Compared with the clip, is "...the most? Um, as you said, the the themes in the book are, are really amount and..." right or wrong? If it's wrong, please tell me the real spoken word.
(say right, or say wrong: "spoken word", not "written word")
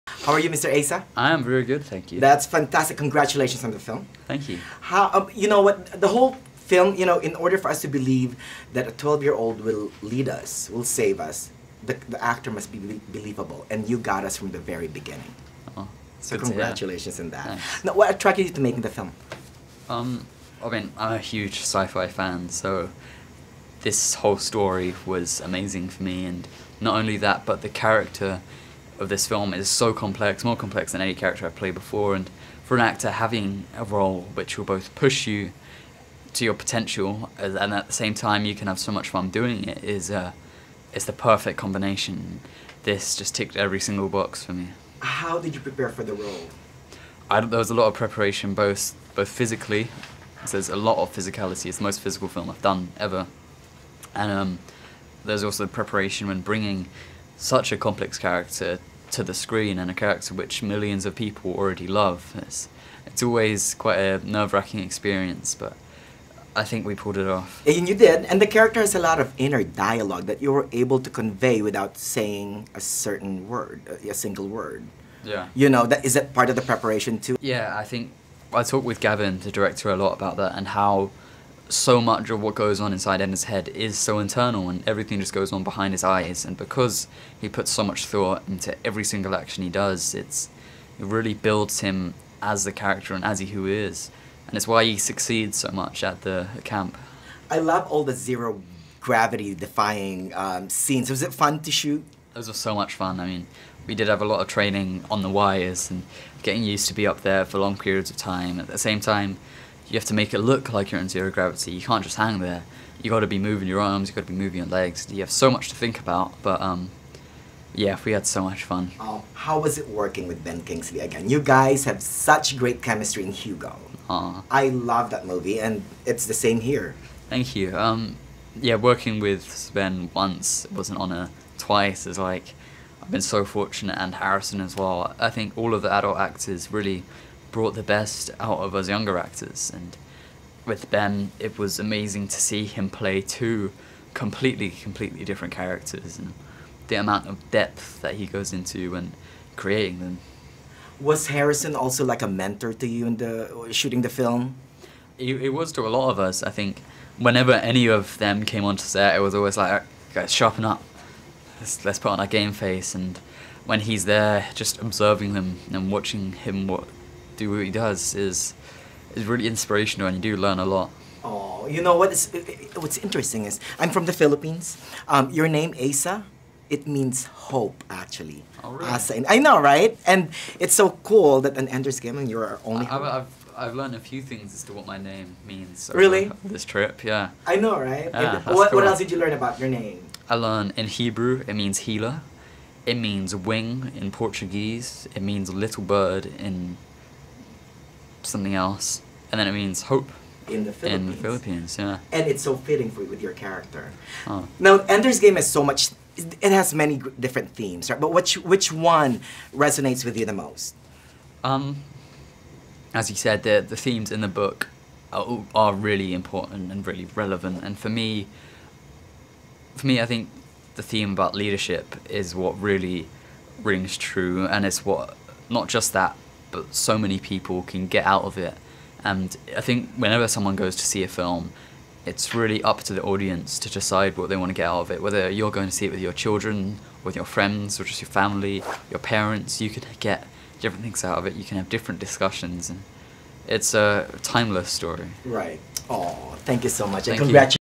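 wrong: "important", not "amount".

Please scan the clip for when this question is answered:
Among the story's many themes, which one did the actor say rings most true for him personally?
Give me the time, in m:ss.
3:41.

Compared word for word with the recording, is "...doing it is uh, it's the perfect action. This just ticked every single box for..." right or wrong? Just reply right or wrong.
wrong.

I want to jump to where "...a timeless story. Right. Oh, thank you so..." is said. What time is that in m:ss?
4:03.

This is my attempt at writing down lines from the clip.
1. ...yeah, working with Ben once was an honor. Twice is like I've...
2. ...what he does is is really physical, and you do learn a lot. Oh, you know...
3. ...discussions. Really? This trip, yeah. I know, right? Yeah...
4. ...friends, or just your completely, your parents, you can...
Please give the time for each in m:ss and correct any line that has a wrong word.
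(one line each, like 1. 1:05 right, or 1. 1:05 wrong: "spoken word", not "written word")
1. 2:08 right
2. 2:47 wrong: "inspirational", not "physical"
3. 3:05 wrong: "means", not "discussions"
4. 3:57 wrong: "family", not "completely".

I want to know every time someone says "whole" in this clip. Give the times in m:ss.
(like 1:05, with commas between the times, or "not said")
0:06, 0:24.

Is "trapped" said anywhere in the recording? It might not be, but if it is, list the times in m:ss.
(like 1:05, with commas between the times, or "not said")
not said.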